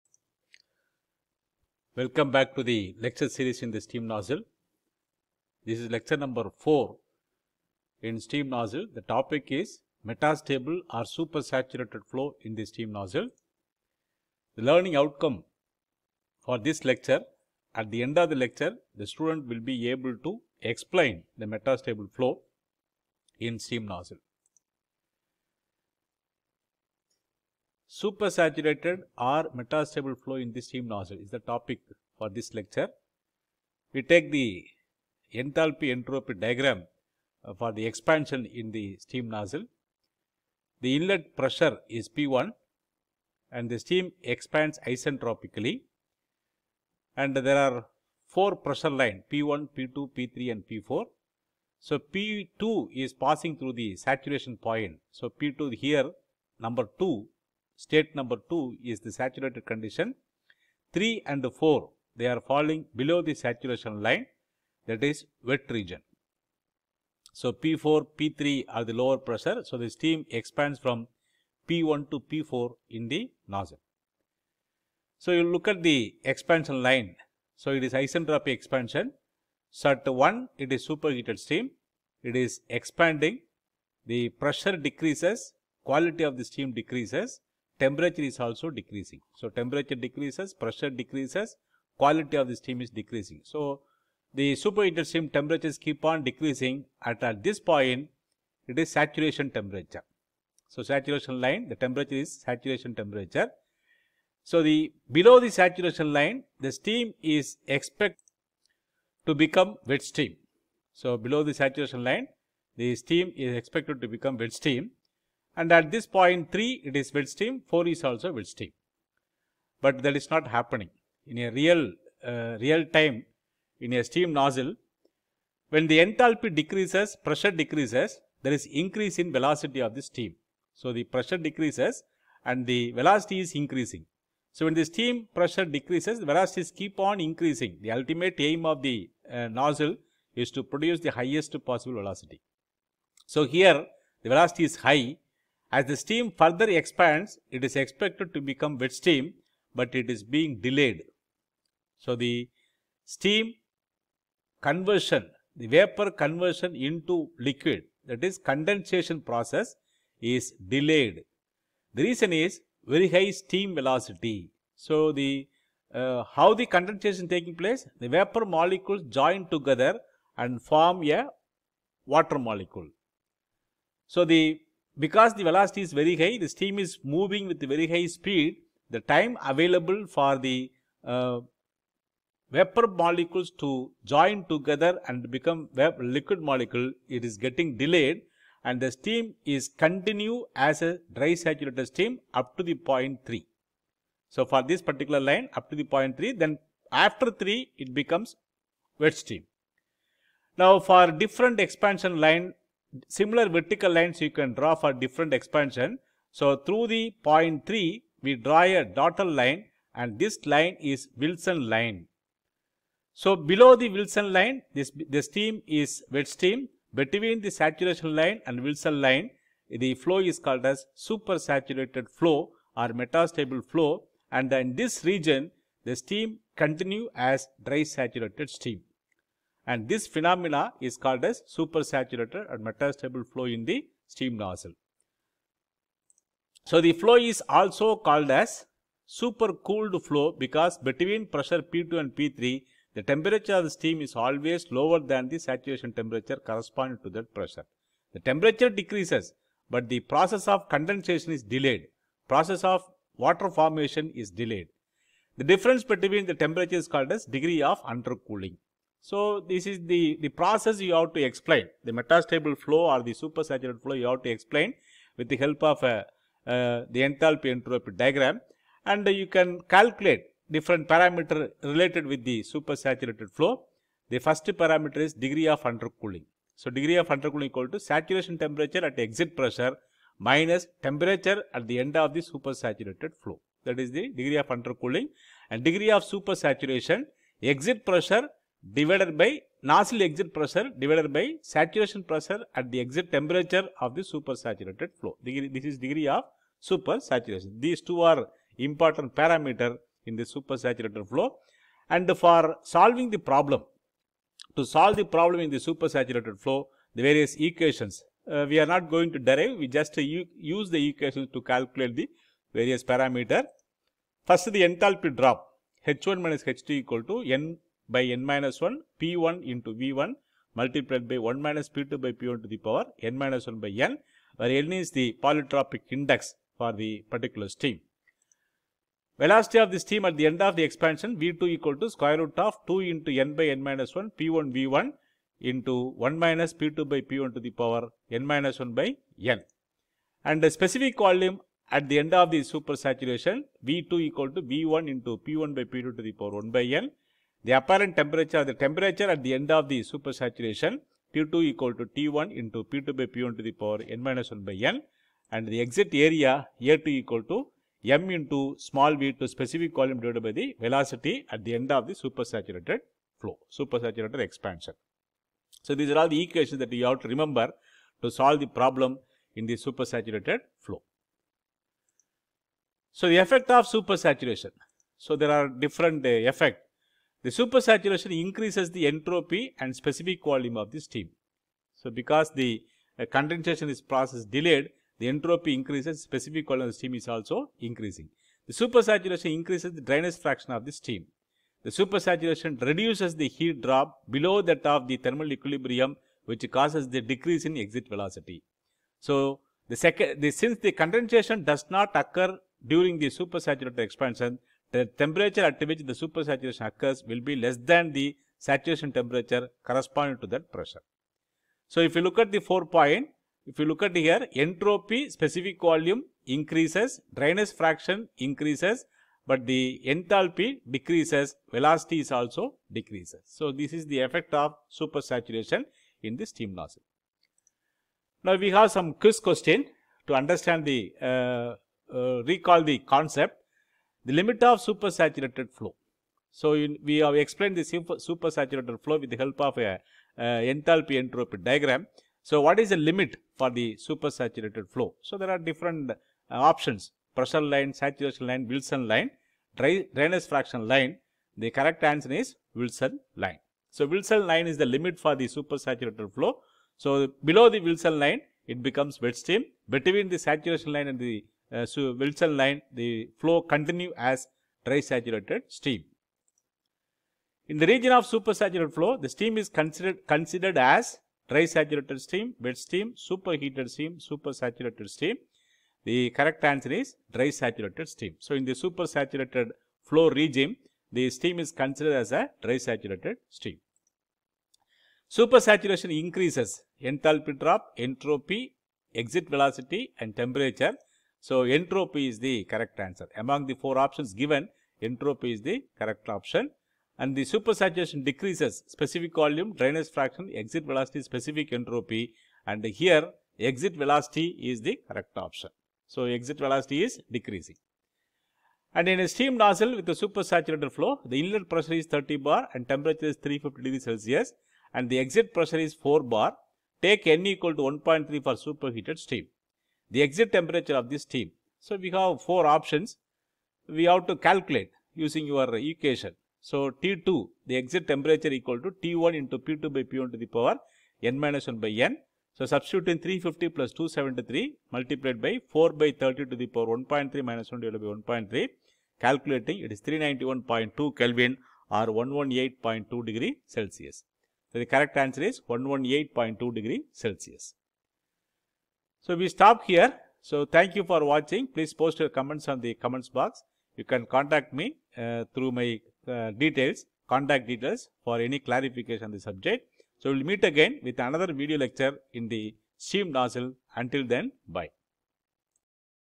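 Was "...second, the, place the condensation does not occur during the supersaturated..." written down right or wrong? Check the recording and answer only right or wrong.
wrong.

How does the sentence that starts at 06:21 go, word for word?
So, because the uh, condensation is process delayed, the entropy increases, specific volume of the steam is also increasing.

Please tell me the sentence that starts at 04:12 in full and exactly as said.
Process of water formation is delayed.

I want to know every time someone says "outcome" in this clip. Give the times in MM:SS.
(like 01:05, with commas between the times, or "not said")
00:14.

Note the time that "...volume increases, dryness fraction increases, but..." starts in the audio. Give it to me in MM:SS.
06:55.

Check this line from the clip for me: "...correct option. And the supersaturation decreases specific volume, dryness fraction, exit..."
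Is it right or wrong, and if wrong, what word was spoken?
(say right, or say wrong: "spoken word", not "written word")
right.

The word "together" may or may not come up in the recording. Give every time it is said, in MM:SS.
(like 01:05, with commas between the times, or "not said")
02:49, 03:04.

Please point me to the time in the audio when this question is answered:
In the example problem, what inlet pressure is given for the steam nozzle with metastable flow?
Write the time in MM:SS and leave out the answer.
08:31.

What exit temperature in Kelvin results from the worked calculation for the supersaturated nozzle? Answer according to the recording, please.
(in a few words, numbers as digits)
391.2 Kelvin.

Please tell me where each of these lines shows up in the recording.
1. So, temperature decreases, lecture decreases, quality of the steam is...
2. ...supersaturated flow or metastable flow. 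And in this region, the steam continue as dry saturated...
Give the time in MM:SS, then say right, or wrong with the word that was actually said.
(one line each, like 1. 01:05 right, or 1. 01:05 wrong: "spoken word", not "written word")
1. 01:29 wrong: "pressure", not "lecture"
2. 03:40 right.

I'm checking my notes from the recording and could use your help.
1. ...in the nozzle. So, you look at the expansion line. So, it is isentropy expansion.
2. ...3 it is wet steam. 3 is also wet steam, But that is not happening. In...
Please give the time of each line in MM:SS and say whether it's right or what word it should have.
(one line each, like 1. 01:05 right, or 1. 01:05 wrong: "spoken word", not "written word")
1. 01:12 right
2. 01:56 wrong: "4", not "3".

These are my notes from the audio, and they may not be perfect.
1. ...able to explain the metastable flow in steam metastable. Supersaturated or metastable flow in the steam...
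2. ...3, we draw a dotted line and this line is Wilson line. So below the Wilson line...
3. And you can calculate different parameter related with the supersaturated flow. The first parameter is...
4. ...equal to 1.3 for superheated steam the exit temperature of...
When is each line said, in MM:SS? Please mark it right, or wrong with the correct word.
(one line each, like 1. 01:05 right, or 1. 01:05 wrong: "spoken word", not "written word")
1. 00:19 wrong: "nozzle", not "metastable"
2. 03:27 right
3. 04:28 right
4. 08:37 right.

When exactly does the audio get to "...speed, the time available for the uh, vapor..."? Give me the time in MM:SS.
02:58.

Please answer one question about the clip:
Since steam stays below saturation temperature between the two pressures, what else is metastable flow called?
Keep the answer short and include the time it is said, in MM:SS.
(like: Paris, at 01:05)
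supercooled flow, at 03:59.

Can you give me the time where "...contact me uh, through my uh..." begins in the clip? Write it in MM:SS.
09:14.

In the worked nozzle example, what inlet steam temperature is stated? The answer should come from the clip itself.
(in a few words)
350 degrees Celsius.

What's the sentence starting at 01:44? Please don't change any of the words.
So, the below the saturation line the steam is expected to become wet steam.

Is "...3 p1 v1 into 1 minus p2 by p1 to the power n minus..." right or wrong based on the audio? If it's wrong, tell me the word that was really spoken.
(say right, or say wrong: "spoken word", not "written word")
wrong: "1", not "3".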